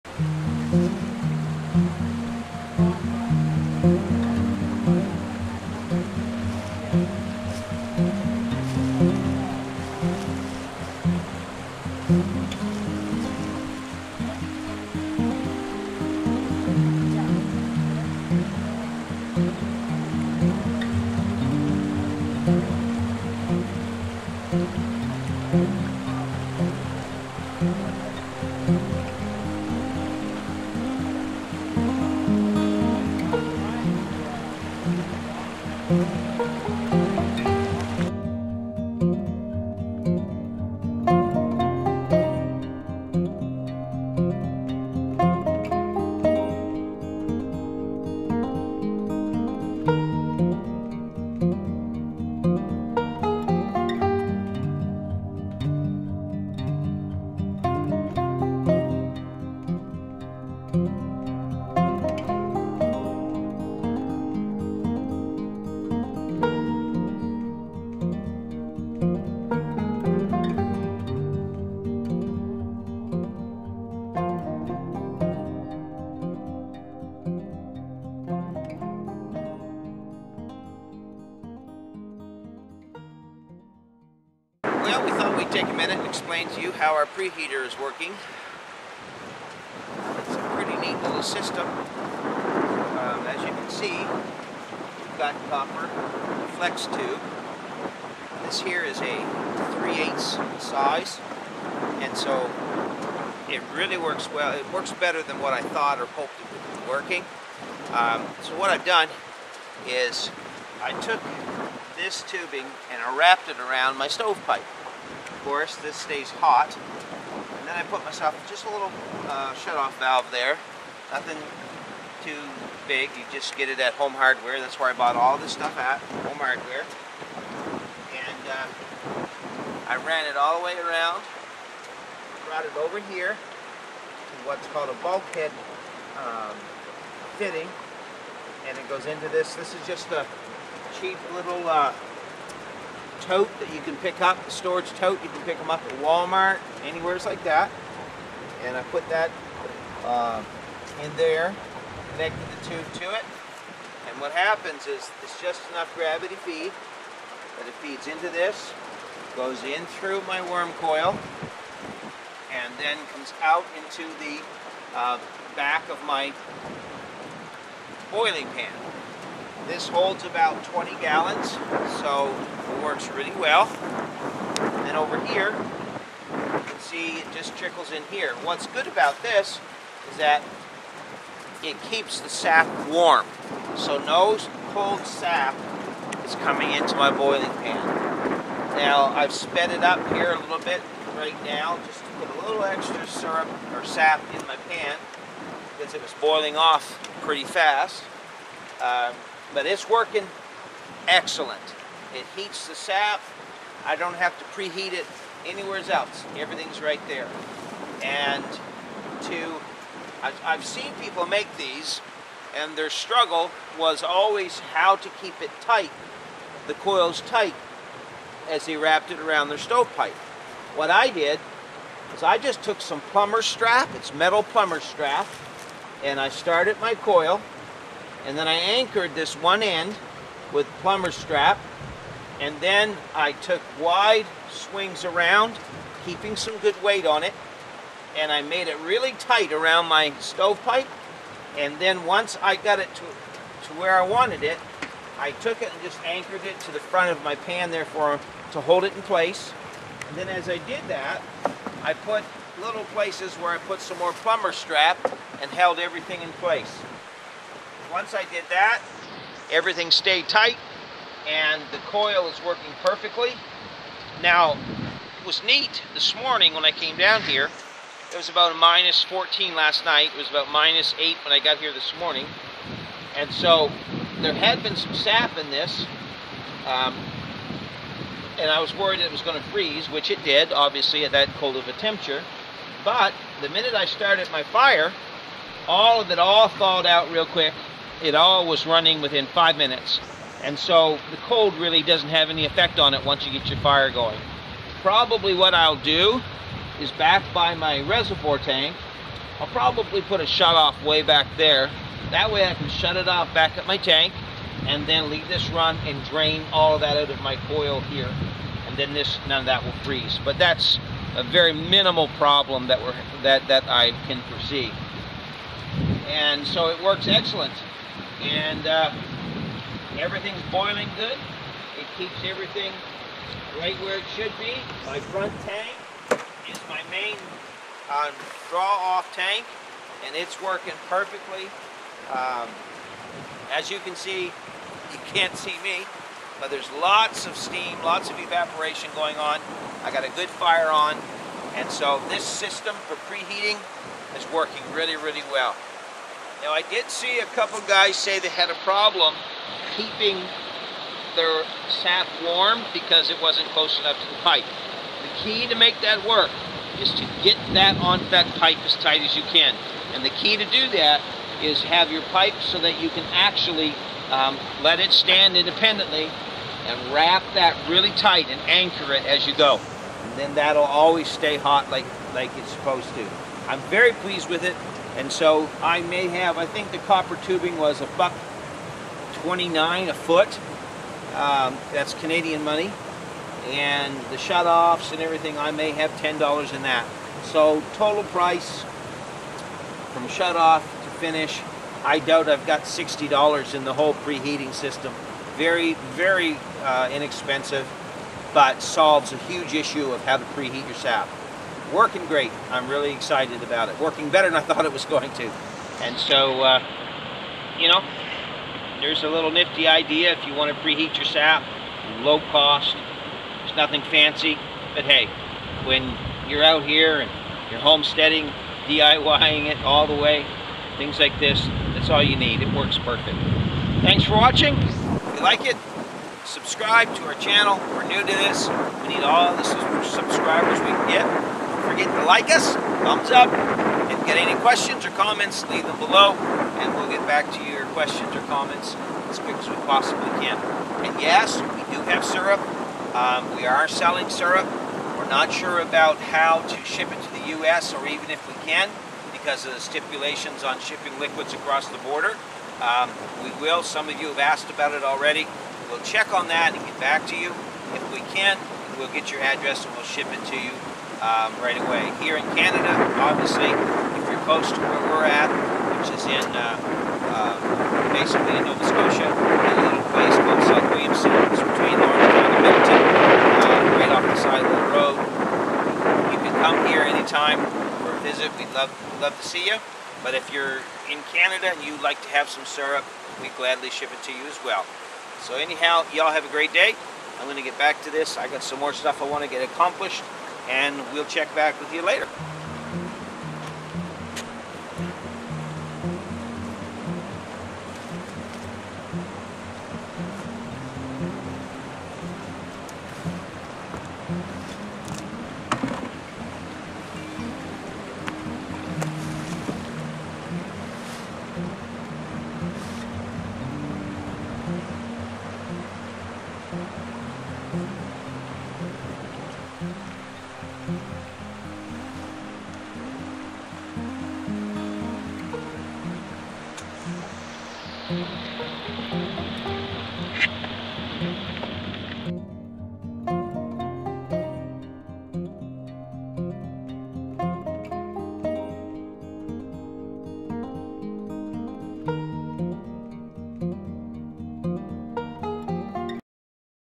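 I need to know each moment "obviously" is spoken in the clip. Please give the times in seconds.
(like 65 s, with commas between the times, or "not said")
280 s, 463 s.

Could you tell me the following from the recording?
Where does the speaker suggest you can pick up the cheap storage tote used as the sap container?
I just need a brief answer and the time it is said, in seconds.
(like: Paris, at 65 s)
Walmart, at 146 s.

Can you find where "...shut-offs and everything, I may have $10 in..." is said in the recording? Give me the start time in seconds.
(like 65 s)
384 s.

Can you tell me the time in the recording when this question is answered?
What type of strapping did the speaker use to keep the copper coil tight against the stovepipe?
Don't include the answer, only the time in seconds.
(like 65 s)
224 s.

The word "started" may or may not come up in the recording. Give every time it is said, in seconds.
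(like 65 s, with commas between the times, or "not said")
226 s, 283 s.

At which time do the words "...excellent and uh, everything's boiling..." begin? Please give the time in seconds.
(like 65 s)
317 s.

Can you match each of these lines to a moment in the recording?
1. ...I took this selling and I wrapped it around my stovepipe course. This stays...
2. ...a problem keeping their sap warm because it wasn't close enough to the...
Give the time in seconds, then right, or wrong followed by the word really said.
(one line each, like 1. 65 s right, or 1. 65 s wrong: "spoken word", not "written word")
1. 110 s wrong: "tubing", not "selling"
2. 348 s right.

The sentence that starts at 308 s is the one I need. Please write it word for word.
And then this, none of that will freeze.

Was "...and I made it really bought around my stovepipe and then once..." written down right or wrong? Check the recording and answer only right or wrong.
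wrong.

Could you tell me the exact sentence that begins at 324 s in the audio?
My front tank is my main uh, draw off tank and it's working perfectly.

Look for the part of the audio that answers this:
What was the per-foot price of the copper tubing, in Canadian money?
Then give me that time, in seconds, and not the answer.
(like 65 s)
377 s.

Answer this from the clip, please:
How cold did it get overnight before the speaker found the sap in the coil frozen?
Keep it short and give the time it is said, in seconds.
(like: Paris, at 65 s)
minus 14, at 268 s.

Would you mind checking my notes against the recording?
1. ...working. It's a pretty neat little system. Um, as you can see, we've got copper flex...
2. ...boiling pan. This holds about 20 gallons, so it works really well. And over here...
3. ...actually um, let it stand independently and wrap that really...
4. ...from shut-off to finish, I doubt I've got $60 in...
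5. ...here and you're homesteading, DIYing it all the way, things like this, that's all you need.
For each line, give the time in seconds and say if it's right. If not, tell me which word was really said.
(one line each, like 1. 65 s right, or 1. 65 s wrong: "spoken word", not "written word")
1. 87 s right
2. 168 s right
3. 363 s right
4. 389 s right
5. 416 s right.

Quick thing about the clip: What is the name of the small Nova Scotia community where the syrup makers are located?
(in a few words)
South Williamston.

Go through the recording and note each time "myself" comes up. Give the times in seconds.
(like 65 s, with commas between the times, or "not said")
118 s.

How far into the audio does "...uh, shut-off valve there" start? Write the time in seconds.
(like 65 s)
119 s.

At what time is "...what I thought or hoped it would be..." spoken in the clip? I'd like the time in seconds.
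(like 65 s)
105 s.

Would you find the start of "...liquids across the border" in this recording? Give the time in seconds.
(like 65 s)
450 s.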